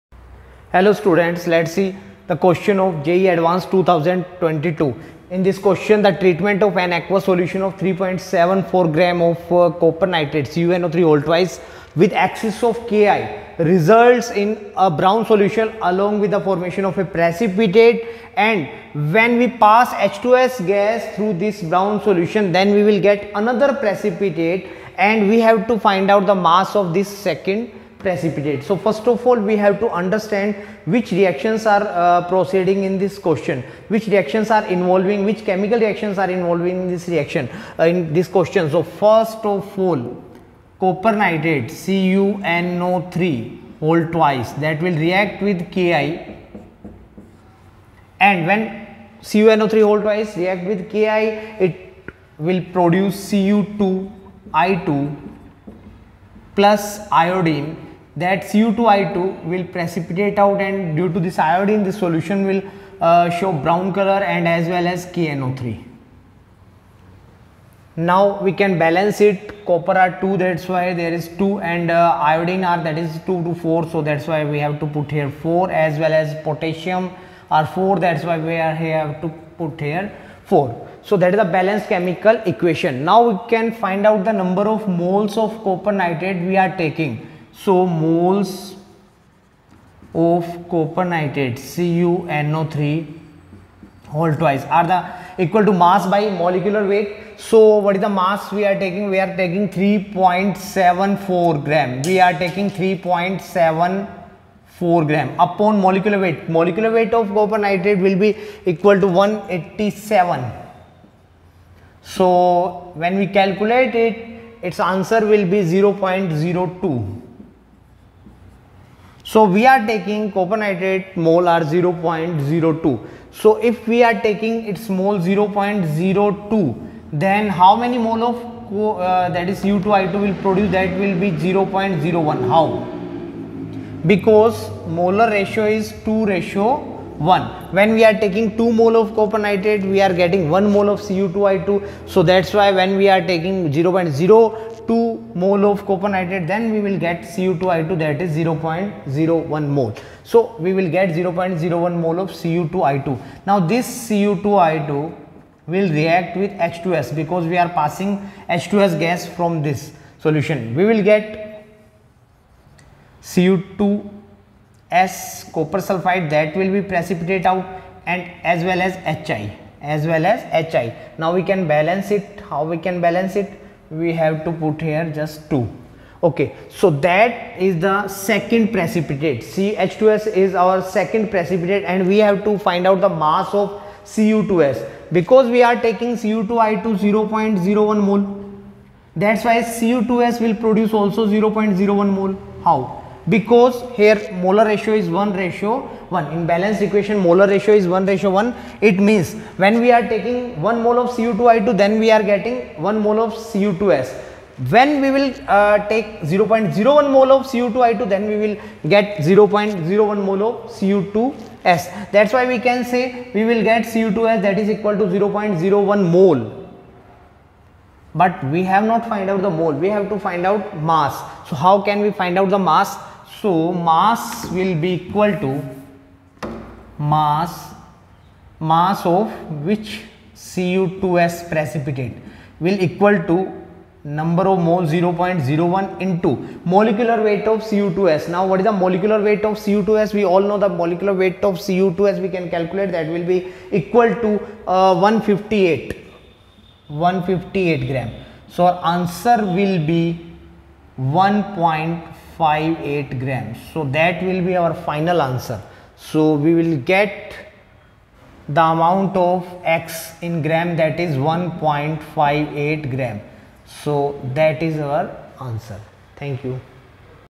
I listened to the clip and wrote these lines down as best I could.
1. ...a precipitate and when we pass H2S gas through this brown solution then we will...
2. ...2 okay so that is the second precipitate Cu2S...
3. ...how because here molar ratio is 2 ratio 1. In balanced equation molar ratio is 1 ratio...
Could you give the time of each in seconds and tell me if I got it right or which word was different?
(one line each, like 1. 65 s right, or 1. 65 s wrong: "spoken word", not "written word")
1. 16 s right
2. 175 s right
3. 192 s wrong: "1", not "2".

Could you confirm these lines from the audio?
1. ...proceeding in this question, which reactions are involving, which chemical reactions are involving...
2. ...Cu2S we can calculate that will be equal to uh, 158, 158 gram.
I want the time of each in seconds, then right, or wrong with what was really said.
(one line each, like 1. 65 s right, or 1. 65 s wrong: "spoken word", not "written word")
1. 32 s right
2. 241 s right.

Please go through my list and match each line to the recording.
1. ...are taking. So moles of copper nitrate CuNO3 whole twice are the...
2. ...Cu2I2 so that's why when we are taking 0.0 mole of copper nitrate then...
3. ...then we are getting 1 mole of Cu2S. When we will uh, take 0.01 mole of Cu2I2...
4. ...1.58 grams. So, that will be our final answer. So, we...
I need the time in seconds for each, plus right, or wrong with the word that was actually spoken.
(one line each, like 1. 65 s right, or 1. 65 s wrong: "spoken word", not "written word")
1. 86 s right
2. 141 s right
3. 201 s right
4. 250 s right.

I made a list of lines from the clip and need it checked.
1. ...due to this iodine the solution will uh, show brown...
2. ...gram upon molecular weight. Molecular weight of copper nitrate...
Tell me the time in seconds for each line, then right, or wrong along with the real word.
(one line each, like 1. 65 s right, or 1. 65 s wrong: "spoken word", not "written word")
1. 60 s right
2. 105 s right.